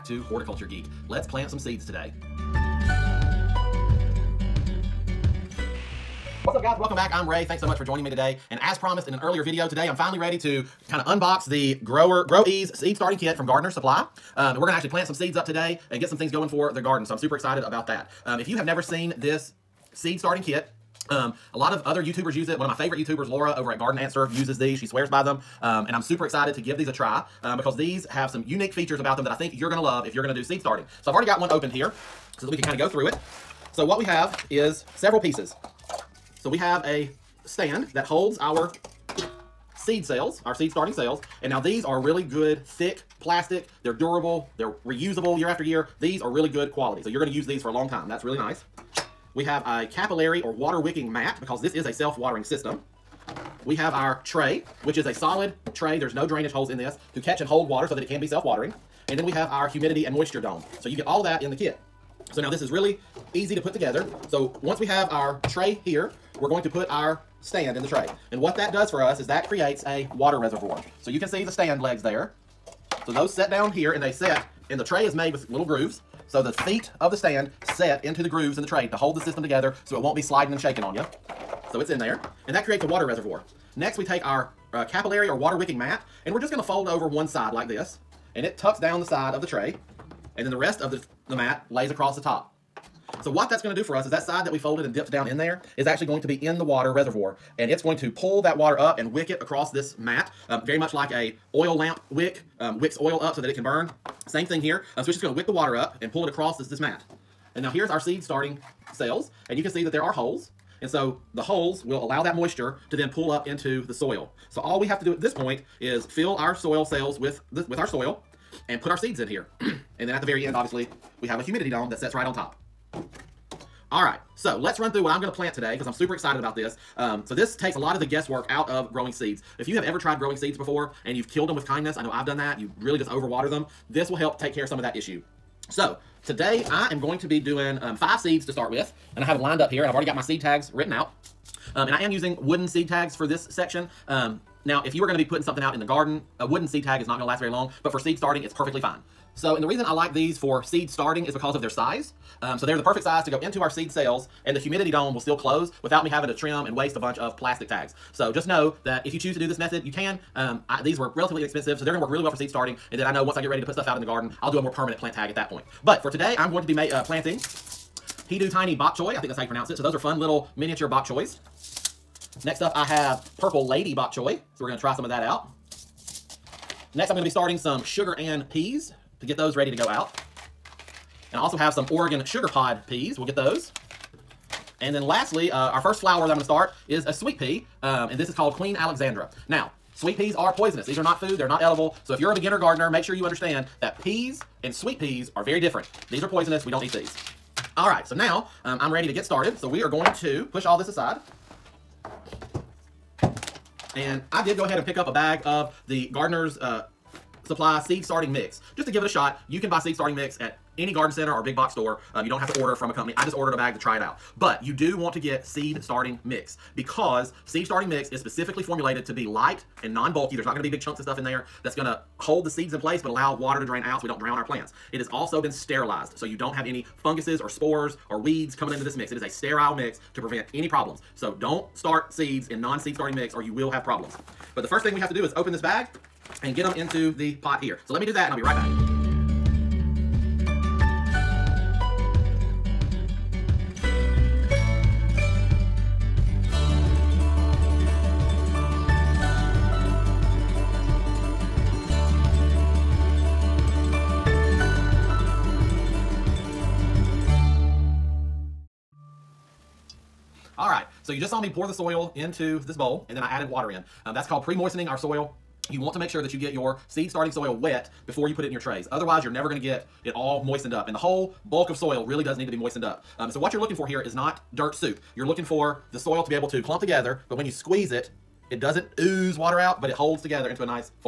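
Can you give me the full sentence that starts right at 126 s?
Um, so this takes a lot of the guesswork out of growing seeds.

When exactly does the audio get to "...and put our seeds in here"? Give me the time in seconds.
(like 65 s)
118 s.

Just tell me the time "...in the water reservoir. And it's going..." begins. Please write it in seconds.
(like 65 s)
96 s.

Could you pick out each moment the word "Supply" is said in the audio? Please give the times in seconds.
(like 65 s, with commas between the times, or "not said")
13 s, 207 s.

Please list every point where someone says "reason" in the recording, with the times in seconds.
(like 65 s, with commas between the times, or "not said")
149 s.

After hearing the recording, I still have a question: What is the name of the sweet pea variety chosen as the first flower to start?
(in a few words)
Queen Alexandra.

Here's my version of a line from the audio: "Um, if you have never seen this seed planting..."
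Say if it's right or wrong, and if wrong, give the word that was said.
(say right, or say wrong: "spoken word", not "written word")
wrong: "starting", not "planting".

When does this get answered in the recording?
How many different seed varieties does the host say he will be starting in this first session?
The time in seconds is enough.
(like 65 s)
137 s.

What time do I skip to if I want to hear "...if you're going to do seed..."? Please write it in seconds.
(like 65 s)
30 s.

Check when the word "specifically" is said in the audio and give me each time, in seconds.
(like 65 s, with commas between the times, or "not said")
218 s.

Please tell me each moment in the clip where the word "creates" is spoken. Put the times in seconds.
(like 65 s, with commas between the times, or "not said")
69 s, 82 s.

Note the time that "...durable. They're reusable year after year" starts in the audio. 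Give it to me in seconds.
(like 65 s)
43 s.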